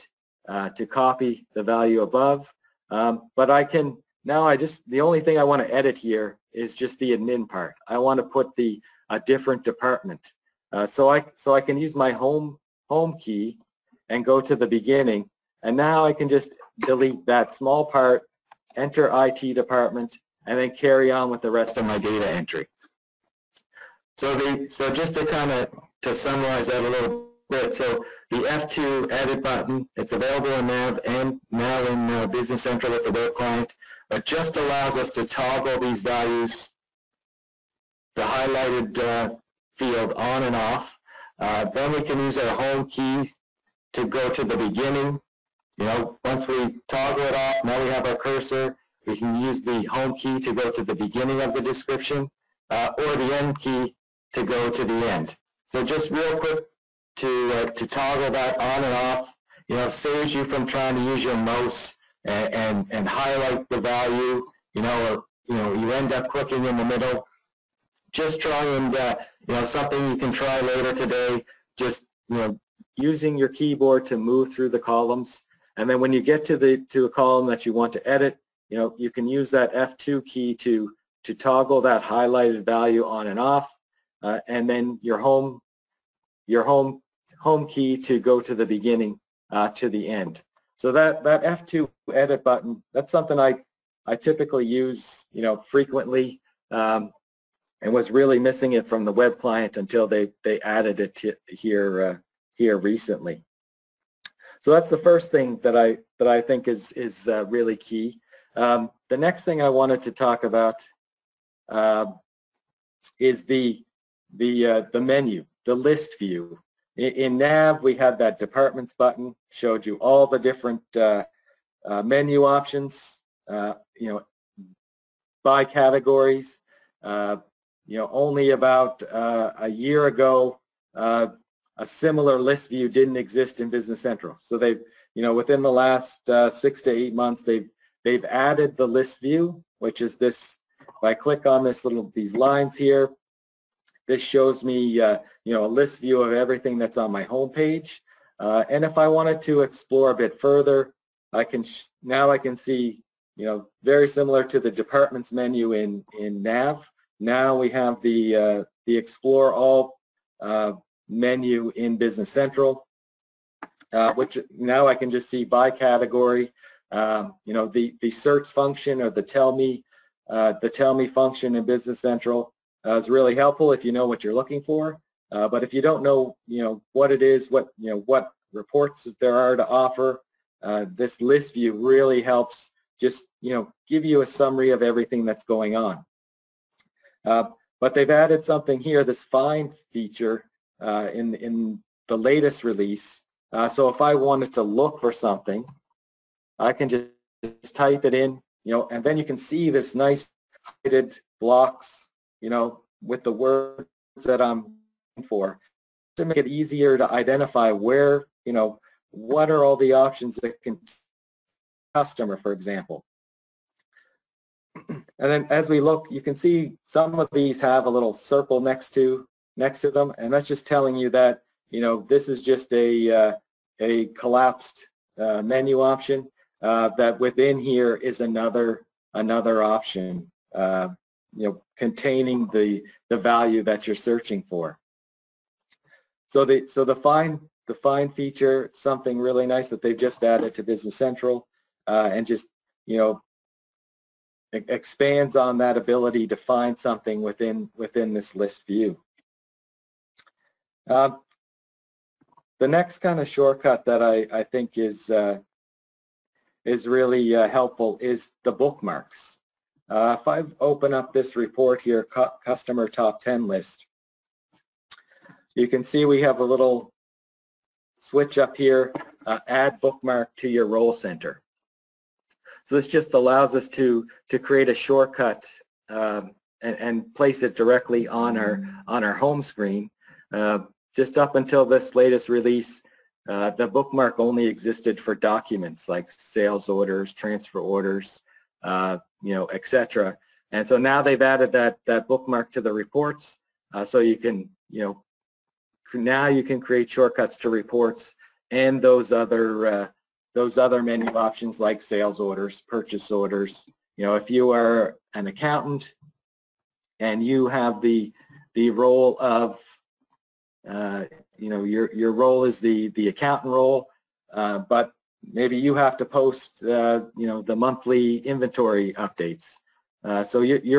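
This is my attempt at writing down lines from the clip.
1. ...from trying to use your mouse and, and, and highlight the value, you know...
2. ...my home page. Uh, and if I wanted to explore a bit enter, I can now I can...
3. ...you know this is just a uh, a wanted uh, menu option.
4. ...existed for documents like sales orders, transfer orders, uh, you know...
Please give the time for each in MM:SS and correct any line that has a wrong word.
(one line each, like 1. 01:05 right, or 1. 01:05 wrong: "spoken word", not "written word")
1. 01:00 right
2. 02:27 wrong: "further", not "enter"
3. 03:41 wrong: "collapsed", not "wanted"
4. 04:44 right.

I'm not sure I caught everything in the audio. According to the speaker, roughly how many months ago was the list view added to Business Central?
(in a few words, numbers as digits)
6 to 8 months.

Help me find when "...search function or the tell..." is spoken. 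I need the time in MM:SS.
02:48.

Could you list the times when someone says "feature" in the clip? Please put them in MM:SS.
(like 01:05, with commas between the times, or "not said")
03:09, 03:58.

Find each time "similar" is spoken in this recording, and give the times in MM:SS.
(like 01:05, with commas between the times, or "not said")
02:11, 02:34.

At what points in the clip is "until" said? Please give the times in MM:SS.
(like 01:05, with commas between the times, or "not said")
01:39, 04:41.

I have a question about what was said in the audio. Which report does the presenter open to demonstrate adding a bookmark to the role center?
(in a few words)
Customer top 10 list.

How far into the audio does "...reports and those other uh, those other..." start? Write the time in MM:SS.
04:57.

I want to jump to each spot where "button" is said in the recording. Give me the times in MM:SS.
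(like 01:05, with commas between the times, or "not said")
00:29, 01:32, 01:58.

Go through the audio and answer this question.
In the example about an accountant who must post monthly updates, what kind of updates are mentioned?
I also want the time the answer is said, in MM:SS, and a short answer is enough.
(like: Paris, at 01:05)
Inventory updates, at 05:18.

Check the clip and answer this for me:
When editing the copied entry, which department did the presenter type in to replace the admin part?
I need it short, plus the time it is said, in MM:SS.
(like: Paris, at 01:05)
IT department, at 00:19.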